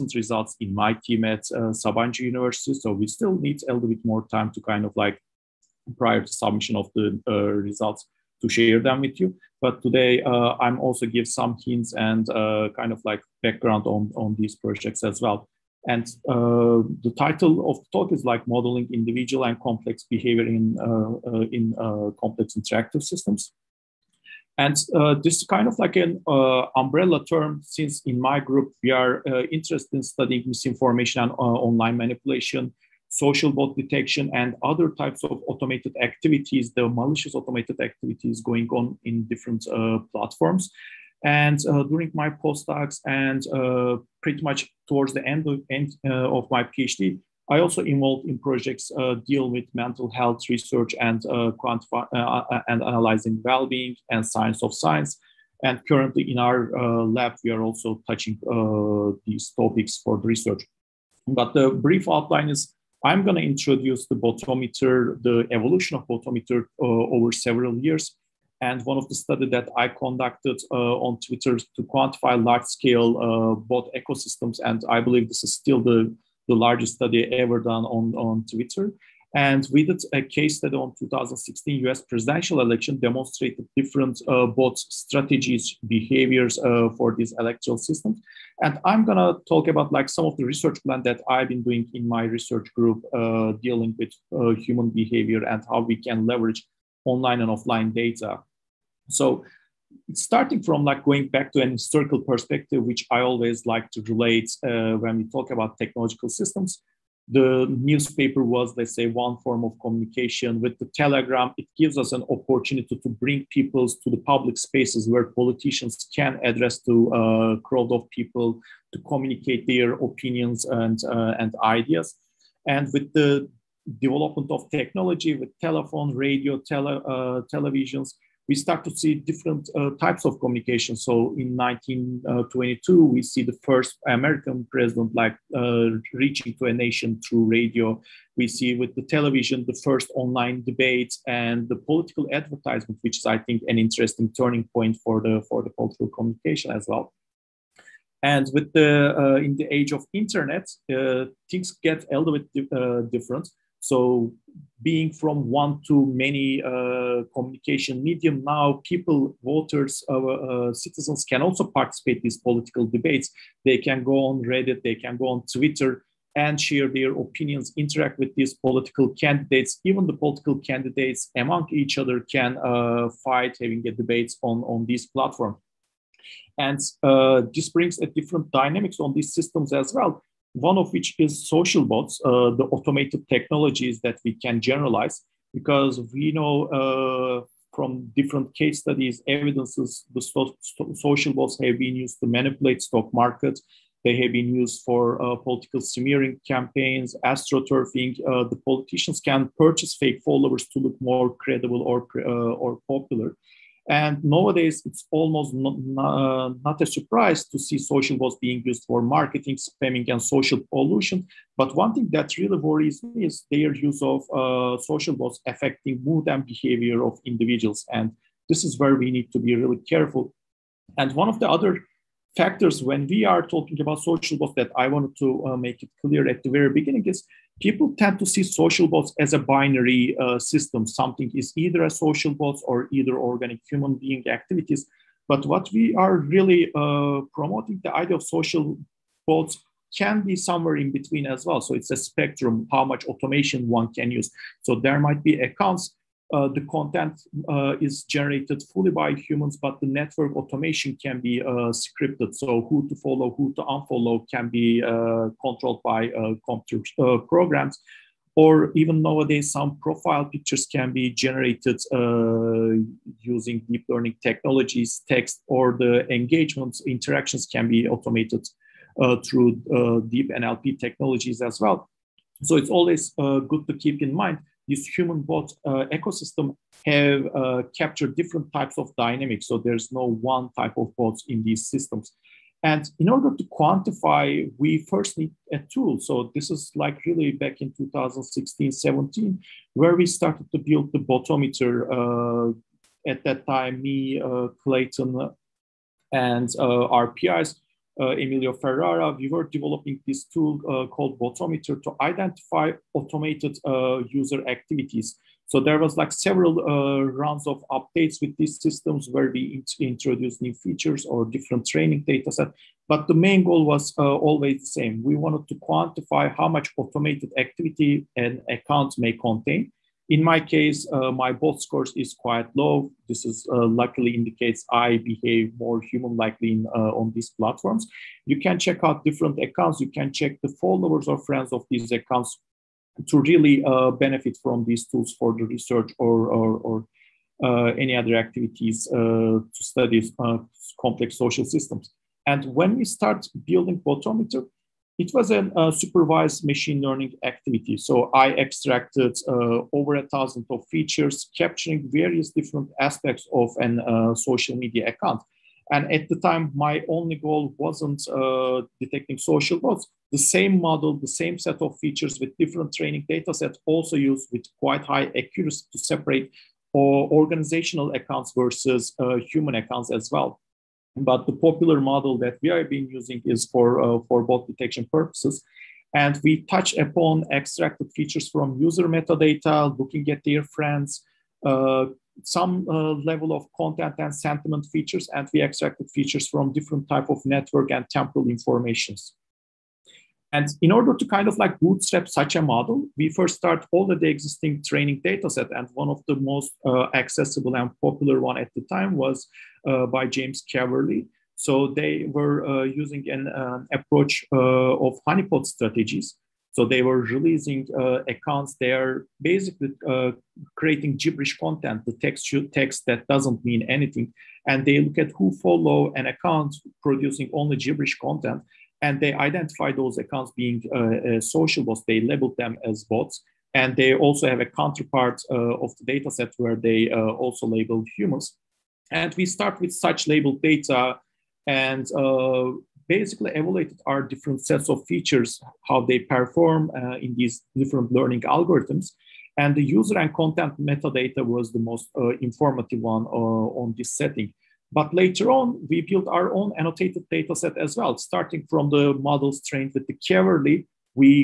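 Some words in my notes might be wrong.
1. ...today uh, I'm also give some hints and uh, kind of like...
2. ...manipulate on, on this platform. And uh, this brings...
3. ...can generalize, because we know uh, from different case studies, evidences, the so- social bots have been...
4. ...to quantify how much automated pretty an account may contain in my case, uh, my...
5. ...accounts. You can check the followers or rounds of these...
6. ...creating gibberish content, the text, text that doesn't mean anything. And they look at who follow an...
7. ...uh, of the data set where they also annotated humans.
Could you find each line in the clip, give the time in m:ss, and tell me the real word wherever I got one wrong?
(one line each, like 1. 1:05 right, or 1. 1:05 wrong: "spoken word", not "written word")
1. 0:09 right
2. 2:53 wrong: "debate", not "manipulate"
3. 3:04 right
4. 5:15 wrong: "activity", not "pretty"
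5. 5:29 wrong: "friends", not "rounds"
6. 6:50 right
7. 7:05 wrong: "labeled", not "annotated".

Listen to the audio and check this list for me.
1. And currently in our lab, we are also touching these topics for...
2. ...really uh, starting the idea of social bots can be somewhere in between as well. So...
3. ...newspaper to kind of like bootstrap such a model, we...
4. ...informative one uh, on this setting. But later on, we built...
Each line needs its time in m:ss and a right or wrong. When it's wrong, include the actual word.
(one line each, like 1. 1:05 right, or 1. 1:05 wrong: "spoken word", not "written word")
1. 0:55 right
2. 3:56 wrong: "promoting", not "starting"
3. 6:30 wrong: "order", not "newspaper"
4. 7:22 right.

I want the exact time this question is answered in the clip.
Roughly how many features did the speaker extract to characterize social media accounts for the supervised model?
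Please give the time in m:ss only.
5:49.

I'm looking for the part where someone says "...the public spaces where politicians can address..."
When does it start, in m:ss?
1:54.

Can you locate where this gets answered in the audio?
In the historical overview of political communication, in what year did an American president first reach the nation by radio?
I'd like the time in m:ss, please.
2:11.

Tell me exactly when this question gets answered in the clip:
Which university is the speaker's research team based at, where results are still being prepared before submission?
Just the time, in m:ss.
0:01.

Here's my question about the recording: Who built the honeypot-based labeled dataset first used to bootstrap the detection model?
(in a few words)
James Caverlee.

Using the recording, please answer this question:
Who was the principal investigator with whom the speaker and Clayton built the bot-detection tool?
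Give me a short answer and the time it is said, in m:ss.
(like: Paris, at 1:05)
Emilio Ferrara, at 4:58.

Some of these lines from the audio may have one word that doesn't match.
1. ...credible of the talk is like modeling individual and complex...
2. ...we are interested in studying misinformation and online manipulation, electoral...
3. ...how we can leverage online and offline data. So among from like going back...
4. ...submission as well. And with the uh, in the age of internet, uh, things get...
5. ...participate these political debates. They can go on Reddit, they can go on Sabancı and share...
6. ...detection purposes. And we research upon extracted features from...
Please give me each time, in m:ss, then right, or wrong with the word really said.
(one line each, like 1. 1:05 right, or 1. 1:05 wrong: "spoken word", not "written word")
1. 0:17 wrong: "title", not "credible"
2. 0:28 wrong: "social", not "electoral"
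3. 1:35 wrong: "starting", not "among"
4. 2:26 wrong: "communication", not "submission"
5. 2:41 wrong: "Twitter", not "Sabancı"
6. 6:14 wrong: "touch", not "research".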